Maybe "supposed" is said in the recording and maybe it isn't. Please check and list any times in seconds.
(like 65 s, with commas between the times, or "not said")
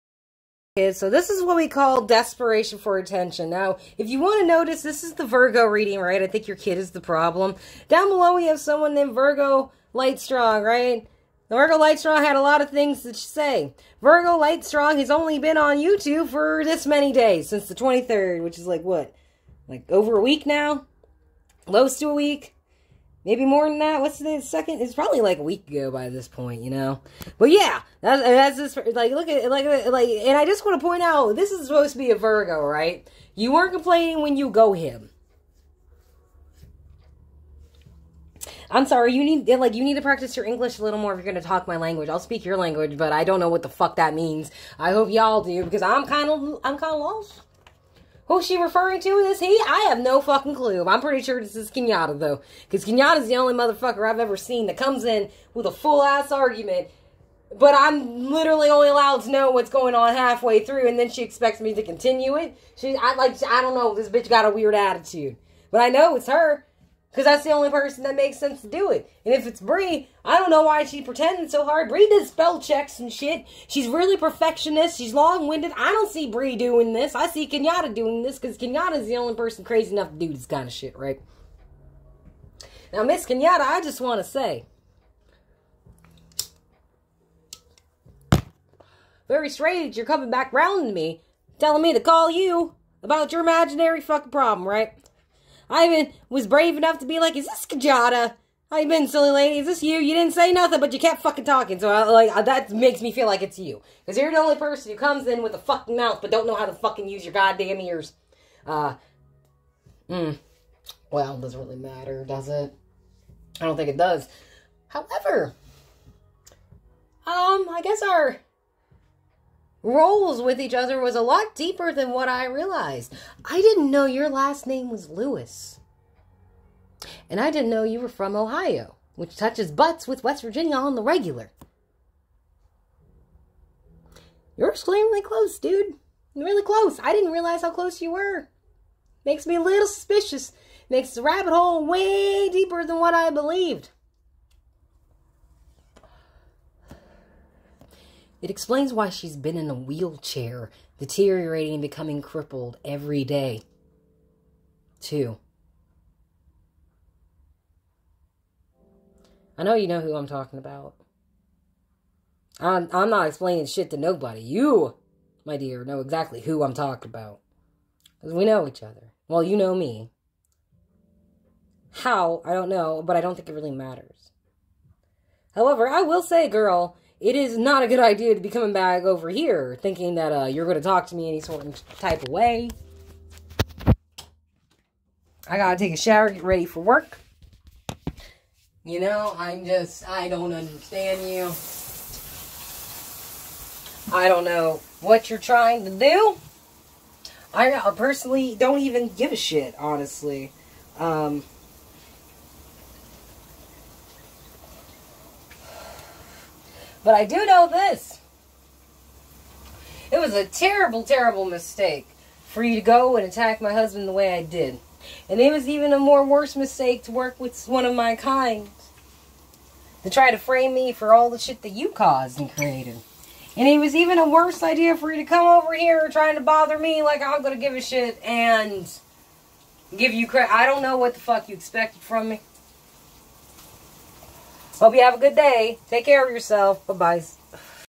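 31 s.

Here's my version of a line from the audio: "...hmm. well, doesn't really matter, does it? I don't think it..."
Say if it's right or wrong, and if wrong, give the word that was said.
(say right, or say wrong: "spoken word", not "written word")
right.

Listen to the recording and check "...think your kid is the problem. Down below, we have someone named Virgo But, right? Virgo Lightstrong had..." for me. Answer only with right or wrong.
wrong.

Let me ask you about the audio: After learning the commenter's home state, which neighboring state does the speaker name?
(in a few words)
West Virginia.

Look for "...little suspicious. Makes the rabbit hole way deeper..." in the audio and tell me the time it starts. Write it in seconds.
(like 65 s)
139 s.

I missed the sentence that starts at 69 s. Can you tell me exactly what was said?
And if it's Bree, I don't know why she's pretending so hard.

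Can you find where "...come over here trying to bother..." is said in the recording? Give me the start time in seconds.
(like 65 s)
225 s.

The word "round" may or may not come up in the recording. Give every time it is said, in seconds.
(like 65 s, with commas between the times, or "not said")
90 s.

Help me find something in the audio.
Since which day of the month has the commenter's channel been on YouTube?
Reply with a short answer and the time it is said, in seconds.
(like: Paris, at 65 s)
23rd, at 17 s.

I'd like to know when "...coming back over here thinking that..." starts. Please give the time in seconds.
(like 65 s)
178 s.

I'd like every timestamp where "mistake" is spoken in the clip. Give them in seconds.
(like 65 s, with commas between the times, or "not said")
211 s, 216 s.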